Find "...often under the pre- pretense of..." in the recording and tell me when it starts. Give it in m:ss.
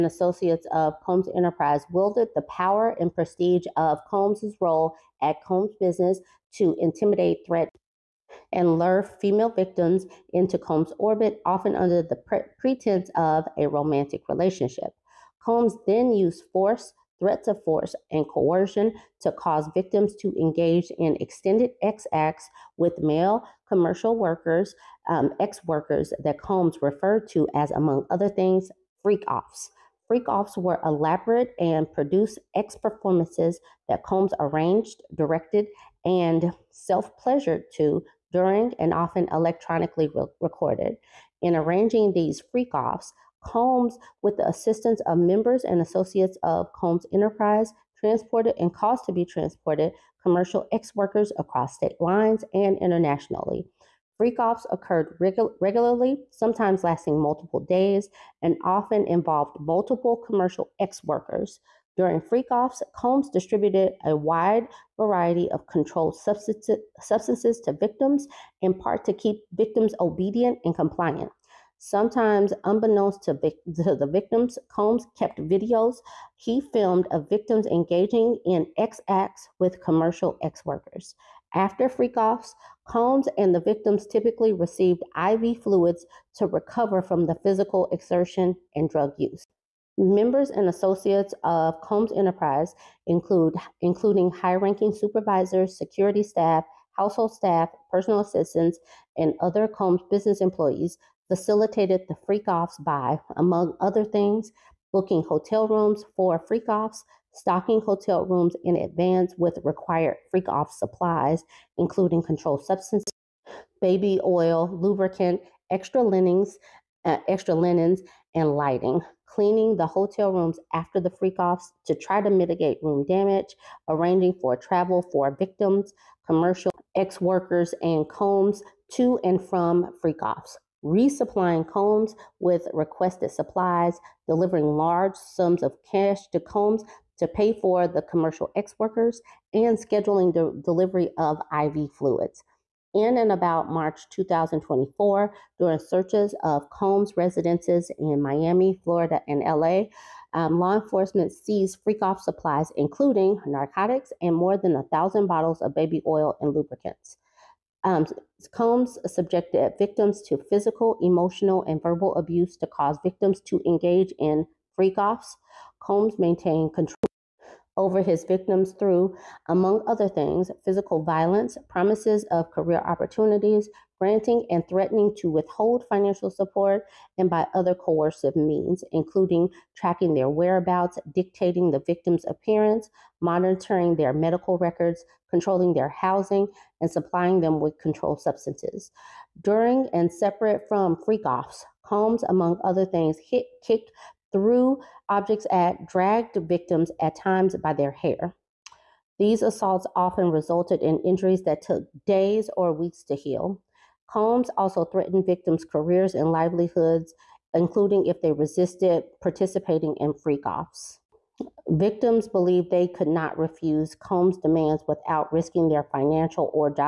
0:11.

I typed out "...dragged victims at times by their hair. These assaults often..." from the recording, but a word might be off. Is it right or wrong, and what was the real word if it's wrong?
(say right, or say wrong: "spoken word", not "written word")
right.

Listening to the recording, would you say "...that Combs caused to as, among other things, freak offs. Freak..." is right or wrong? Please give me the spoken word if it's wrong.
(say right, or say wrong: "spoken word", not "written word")
wrong: "referred", not "caused".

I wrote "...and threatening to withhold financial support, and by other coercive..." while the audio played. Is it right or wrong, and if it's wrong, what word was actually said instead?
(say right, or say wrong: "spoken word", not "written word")
right.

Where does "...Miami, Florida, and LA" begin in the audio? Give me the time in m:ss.
2:28.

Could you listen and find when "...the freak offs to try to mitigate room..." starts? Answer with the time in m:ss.
2:00.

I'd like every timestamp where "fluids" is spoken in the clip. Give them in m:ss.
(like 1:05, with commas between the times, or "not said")
1:25, 2:21.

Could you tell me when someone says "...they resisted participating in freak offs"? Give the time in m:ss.
3:28.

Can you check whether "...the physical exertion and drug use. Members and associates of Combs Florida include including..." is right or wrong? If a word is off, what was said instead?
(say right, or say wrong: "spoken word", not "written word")
wrong: "Enterprise", not "Florida".